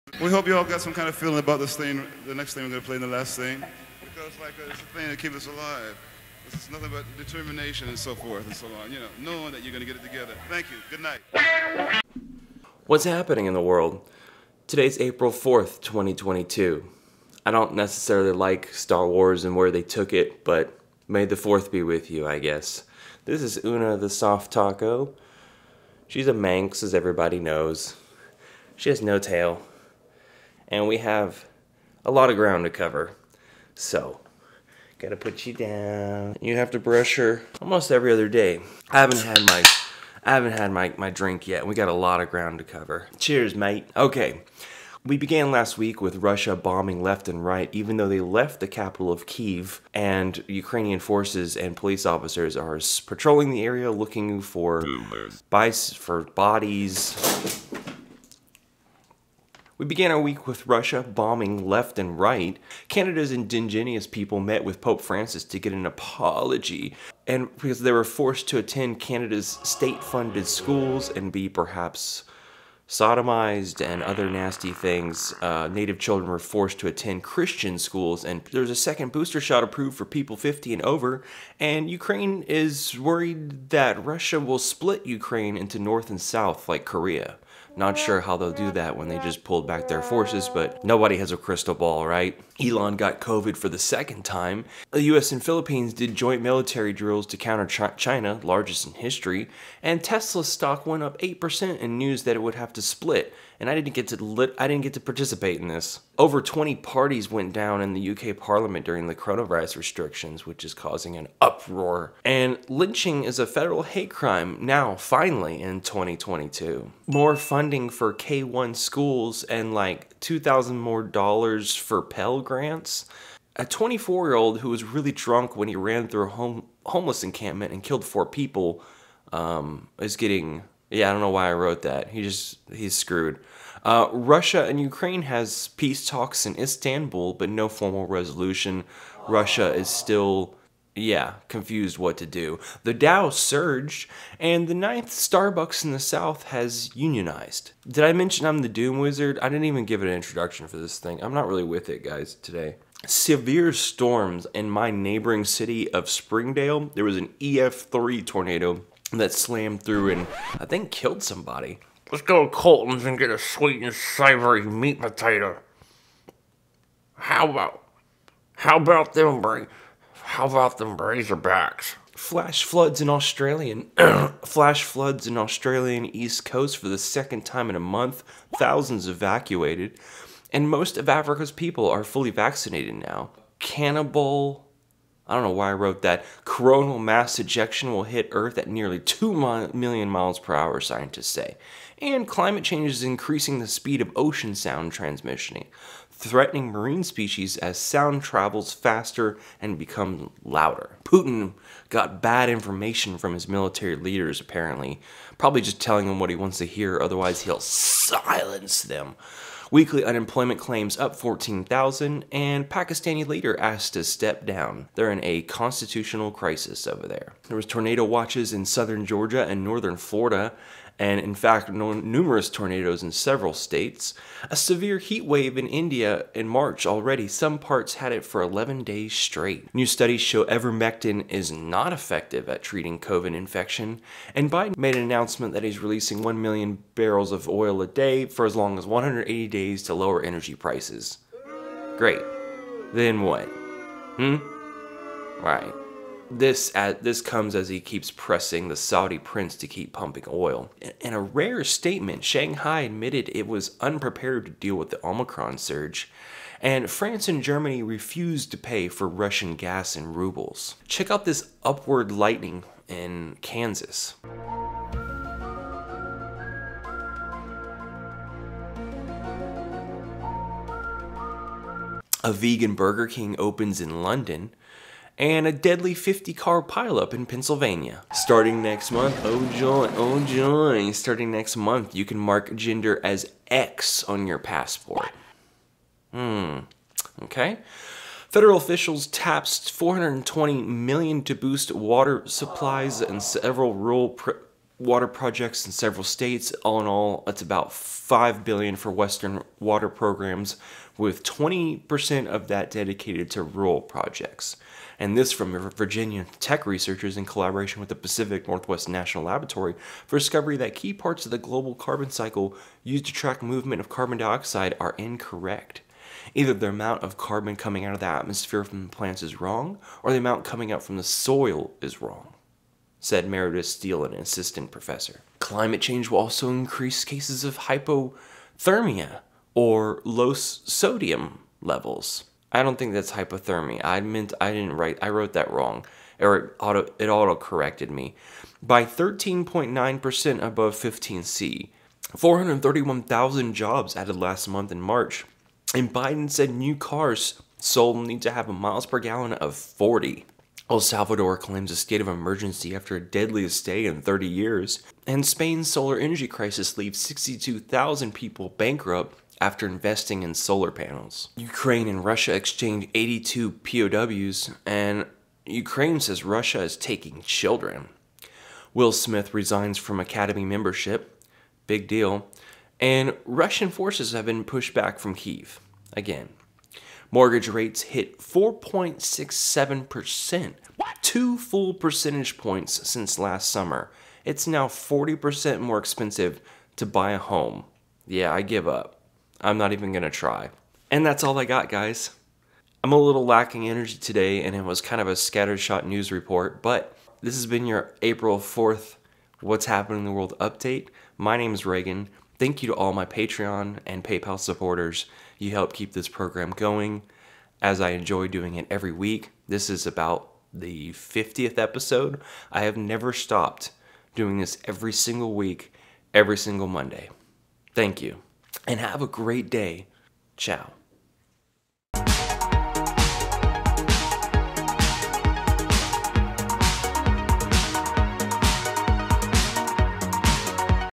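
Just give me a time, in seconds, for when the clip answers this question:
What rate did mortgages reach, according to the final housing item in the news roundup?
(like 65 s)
378 s.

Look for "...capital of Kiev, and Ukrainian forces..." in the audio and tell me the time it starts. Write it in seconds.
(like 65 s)
48 s.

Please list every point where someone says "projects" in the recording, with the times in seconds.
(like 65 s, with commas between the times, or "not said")
295 s, 303 s.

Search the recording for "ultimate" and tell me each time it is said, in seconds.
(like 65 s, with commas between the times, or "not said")
not said.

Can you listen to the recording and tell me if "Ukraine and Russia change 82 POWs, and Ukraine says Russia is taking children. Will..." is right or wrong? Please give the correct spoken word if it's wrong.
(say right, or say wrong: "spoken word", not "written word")
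wrong: "exchange", not "change".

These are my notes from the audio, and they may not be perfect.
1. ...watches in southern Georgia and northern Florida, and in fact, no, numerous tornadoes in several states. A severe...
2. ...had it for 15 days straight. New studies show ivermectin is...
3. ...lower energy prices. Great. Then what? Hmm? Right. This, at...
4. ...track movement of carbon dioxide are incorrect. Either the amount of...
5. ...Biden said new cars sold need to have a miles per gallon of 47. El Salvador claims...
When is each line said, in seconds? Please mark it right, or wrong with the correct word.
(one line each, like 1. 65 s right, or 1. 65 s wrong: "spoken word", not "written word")
1. 218 s right
2. 227 s wrong: "11", not "15"
3. 239 s right
4. 313 s right
5. 345 s wrong: "40", not "47".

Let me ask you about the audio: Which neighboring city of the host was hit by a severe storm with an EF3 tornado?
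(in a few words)
Springdale.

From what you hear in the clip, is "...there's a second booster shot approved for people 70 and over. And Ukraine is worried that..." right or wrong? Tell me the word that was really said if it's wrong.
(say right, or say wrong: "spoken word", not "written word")
wrong: "50", not "70".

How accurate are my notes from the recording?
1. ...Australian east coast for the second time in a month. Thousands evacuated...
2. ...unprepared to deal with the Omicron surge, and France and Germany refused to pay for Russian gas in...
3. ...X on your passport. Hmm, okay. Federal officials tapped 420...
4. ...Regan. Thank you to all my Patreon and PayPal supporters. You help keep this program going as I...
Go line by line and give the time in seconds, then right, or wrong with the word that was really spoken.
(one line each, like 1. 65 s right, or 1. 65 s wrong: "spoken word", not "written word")
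1. 175 s right
2. 253 s right
3. 283 s right
4. 401 s right.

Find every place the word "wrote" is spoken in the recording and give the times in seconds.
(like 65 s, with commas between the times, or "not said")
131 s, 185 s, 335 s.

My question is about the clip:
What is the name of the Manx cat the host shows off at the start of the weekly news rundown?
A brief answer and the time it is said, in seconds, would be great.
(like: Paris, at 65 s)
Una the Soft Taco, at 23 s.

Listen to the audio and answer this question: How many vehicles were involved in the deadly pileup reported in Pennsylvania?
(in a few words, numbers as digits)
50.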